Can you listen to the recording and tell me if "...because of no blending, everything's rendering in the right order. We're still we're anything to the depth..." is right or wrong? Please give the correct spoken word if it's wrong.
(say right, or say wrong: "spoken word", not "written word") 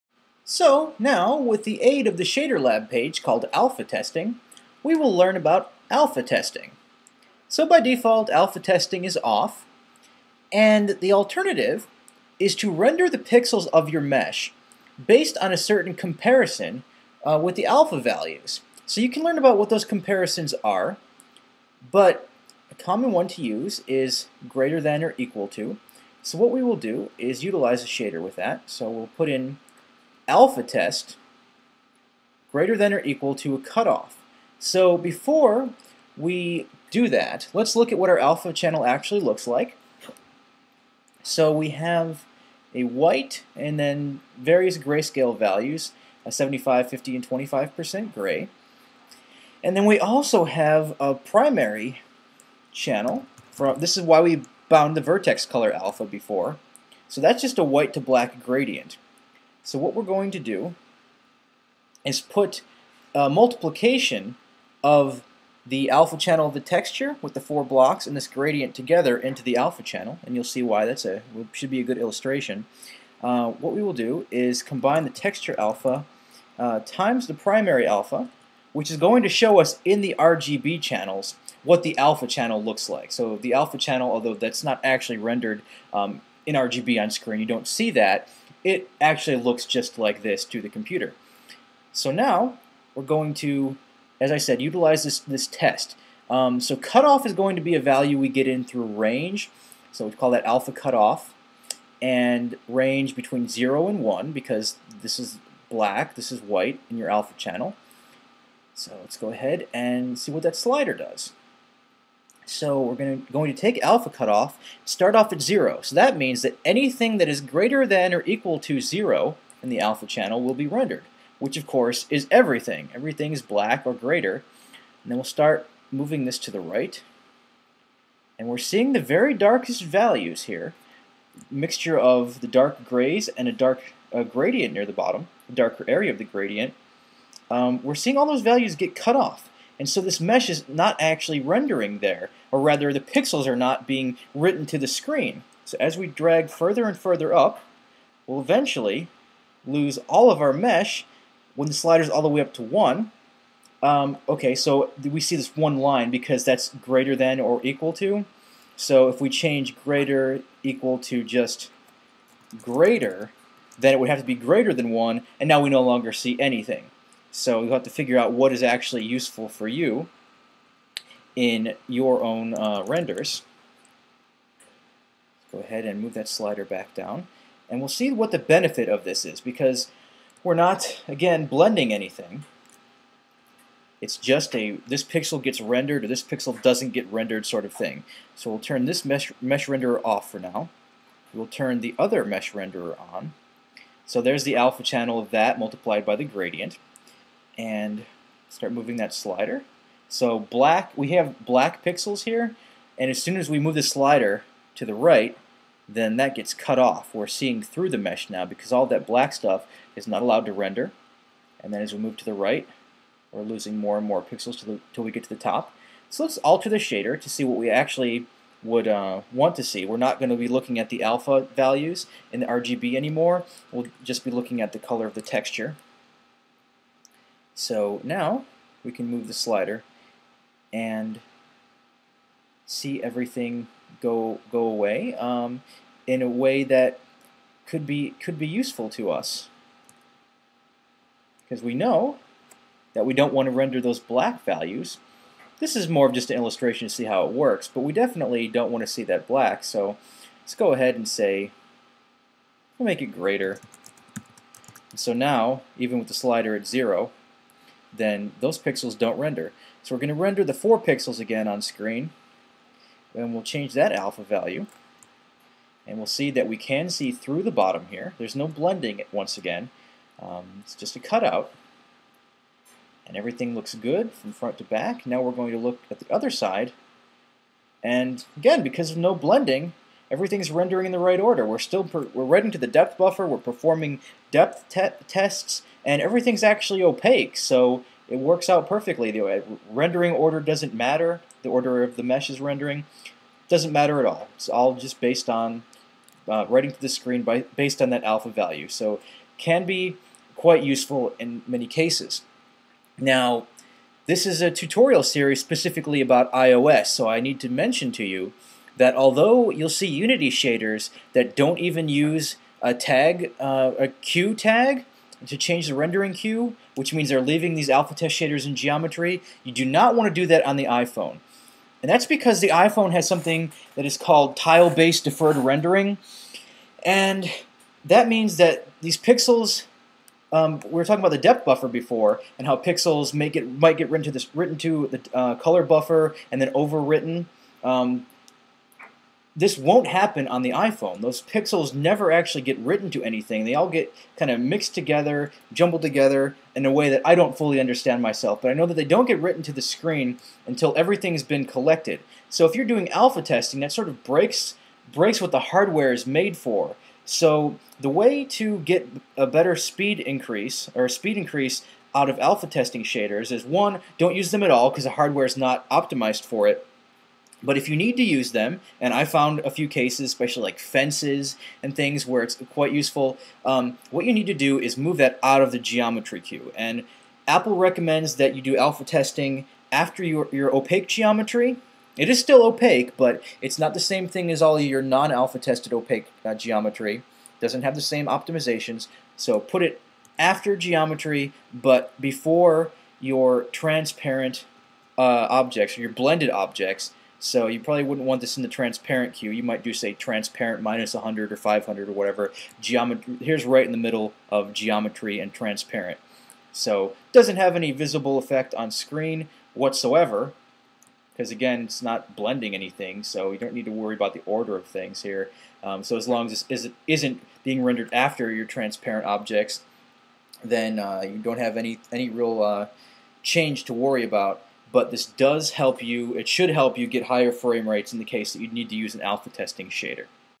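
wrong: "writing", not "anything".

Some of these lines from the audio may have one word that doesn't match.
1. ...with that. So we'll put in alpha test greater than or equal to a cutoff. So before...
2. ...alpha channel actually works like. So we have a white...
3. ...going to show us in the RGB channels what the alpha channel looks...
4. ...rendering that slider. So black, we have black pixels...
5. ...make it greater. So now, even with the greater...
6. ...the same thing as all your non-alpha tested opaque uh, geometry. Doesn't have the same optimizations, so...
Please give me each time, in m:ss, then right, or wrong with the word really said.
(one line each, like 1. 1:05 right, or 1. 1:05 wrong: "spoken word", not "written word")
1. 0:28 right
2. 0:38 wrong: "looks", not "works"
3. 1:18 right
4. 3:18 wrong: "moving", not "rendering"
5. 4:12 wrong: "slider", not "greater"
6. 6:23 right.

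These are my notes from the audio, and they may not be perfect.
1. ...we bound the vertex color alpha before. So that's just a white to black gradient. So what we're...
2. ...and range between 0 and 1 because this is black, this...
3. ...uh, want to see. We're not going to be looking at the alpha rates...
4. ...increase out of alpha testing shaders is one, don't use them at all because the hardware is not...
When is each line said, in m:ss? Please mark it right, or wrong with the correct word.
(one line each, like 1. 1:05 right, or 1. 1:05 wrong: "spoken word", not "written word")
1. 0:54 right
2. 1:42 right
3. 3:38 wrong: "values", not "rates"
4. 6:01 right.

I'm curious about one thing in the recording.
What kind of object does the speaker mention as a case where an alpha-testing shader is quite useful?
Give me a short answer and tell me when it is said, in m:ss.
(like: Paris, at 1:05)
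fences, at 6:10.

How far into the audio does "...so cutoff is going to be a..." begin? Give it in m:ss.
1:36.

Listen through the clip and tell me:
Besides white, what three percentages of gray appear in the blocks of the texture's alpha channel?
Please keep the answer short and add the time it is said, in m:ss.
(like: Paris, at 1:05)
75, 50, and 25%, at 0:46.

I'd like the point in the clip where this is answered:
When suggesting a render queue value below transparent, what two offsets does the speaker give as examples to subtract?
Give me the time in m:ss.
6:40.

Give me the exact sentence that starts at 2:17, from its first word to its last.
Um, we're seeing all those values get cut off.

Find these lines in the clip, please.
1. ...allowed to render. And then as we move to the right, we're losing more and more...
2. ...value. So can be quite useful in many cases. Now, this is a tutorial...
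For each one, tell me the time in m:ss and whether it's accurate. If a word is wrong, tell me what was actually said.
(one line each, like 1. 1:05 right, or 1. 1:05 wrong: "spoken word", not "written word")
1. 3:30 right
2. 4:58 right.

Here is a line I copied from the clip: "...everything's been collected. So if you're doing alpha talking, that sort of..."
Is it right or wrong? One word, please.
wrong.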